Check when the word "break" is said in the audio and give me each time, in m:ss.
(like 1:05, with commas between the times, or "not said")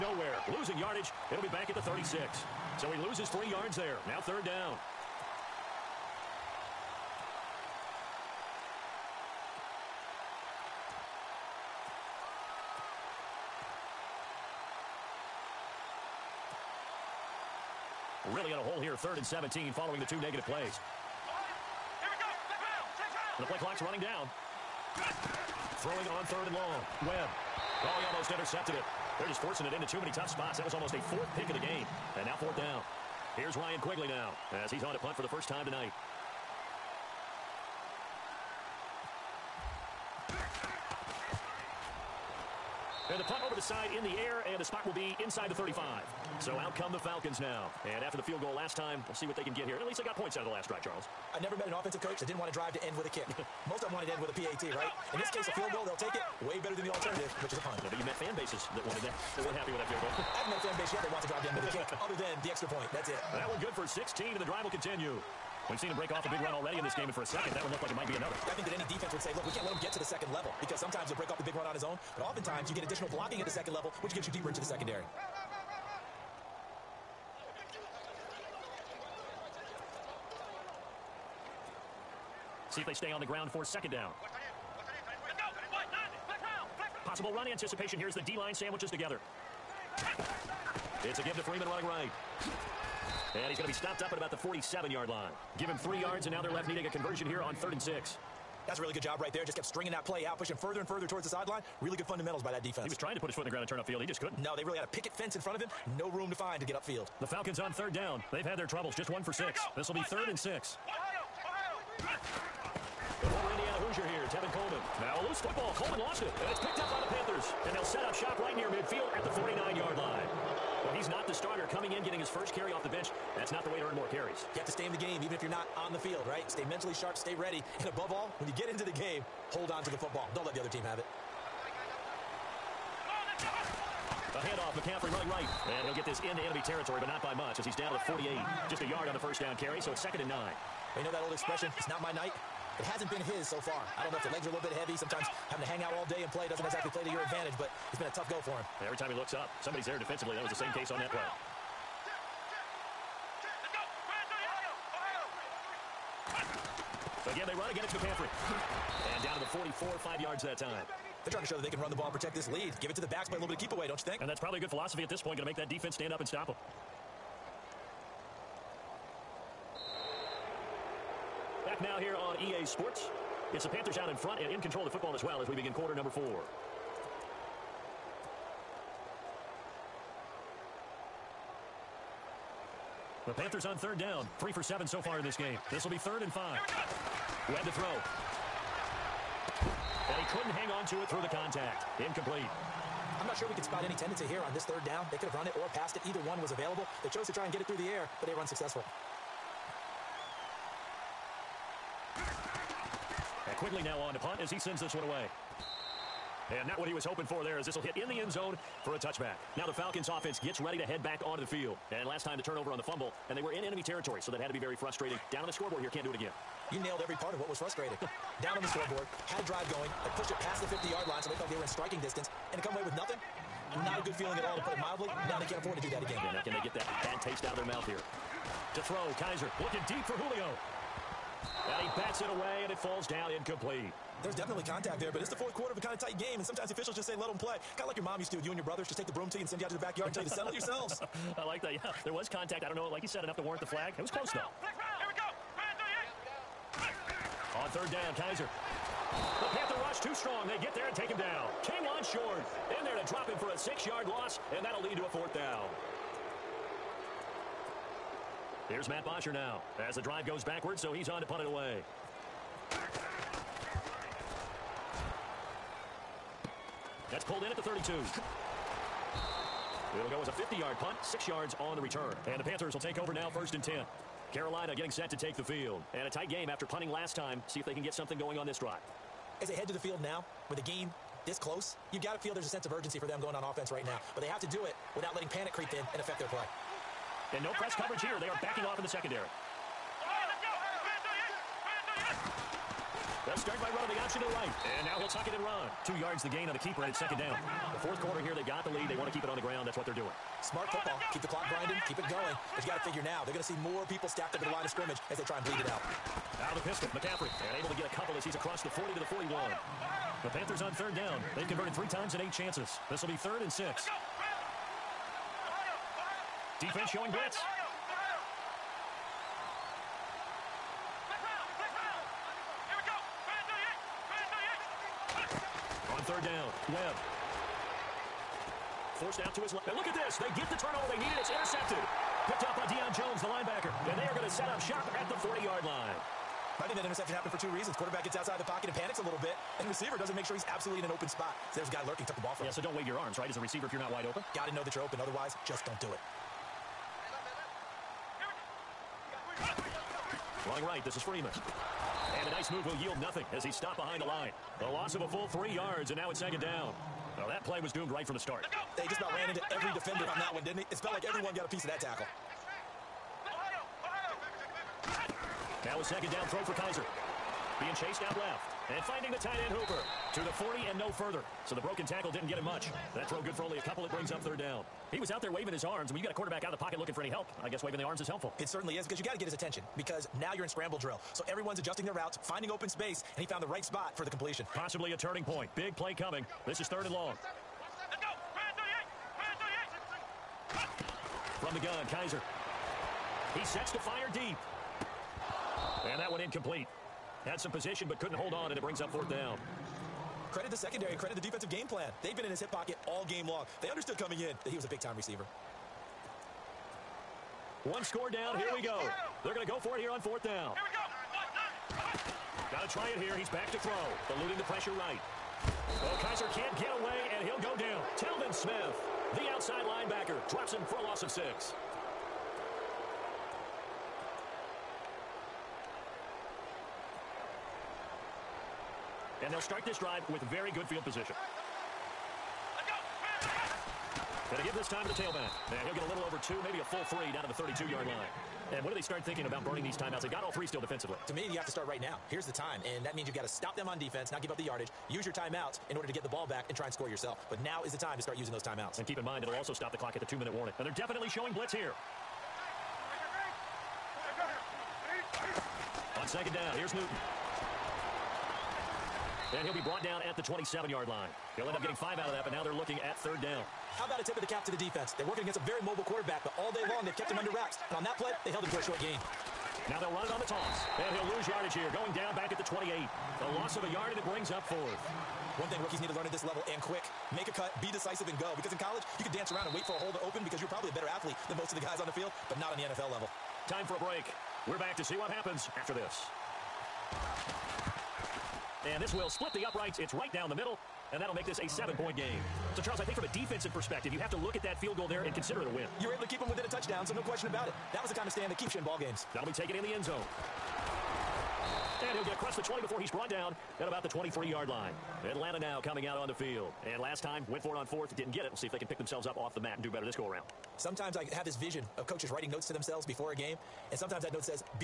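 1:05, 1:11, 8:03.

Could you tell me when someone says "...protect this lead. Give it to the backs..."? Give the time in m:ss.
2:42.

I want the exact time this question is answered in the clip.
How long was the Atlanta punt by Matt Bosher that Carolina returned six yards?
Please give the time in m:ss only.
4:30.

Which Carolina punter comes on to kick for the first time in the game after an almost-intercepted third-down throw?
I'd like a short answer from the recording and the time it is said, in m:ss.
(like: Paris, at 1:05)
Ryan Quigley, at 0:33.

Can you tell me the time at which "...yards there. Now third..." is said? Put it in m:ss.
0:03.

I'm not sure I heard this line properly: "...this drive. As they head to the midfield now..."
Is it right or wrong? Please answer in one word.
wrong.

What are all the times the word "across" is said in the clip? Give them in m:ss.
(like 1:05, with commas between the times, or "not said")
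5:08, 8:22.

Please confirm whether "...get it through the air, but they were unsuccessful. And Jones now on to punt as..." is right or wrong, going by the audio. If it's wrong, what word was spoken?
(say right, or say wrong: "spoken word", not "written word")
wrong: "Quigley", not "Jones".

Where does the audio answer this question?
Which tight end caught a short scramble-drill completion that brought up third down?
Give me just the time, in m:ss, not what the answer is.
6:09.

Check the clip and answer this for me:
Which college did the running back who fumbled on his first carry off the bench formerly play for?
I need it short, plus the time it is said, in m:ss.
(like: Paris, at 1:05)
Indiana, at 1:53.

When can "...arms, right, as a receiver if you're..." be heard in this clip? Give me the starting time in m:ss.
5:42.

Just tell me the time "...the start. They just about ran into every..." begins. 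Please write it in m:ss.
5:58.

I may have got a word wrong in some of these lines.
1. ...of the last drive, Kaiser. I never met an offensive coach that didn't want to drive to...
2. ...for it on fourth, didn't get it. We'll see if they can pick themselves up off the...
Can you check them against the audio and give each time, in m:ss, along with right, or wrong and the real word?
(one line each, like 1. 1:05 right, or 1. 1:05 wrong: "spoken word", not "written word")
1. 0:50 wrong: "Charles", not "Kaiser"
2. 8:27 right.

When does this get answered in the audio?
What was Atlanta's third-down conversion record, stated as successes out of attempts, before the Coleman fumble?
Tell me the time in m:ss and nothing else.
1:49.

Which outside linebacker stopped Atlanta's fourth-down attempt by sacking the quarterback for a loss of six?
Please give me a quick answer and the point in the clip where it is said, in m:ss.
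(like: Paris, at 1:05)
Telvin Smith, at 6:57.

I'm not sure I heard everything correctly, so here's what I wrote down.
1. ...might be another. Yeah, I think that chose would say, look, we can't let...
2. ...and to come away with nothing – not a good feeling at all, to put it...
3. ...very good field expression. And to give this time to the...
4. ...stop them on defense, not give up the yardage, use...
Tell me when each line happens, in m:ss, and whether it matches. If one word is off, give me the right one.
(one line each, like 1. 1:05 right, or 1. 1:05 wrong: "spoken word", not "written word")
1. 1:07 wrong: "defense", not "chose"
2. 3:42 right
3. 7:10 wrong: "position", not "expression"
4. 7:23 right.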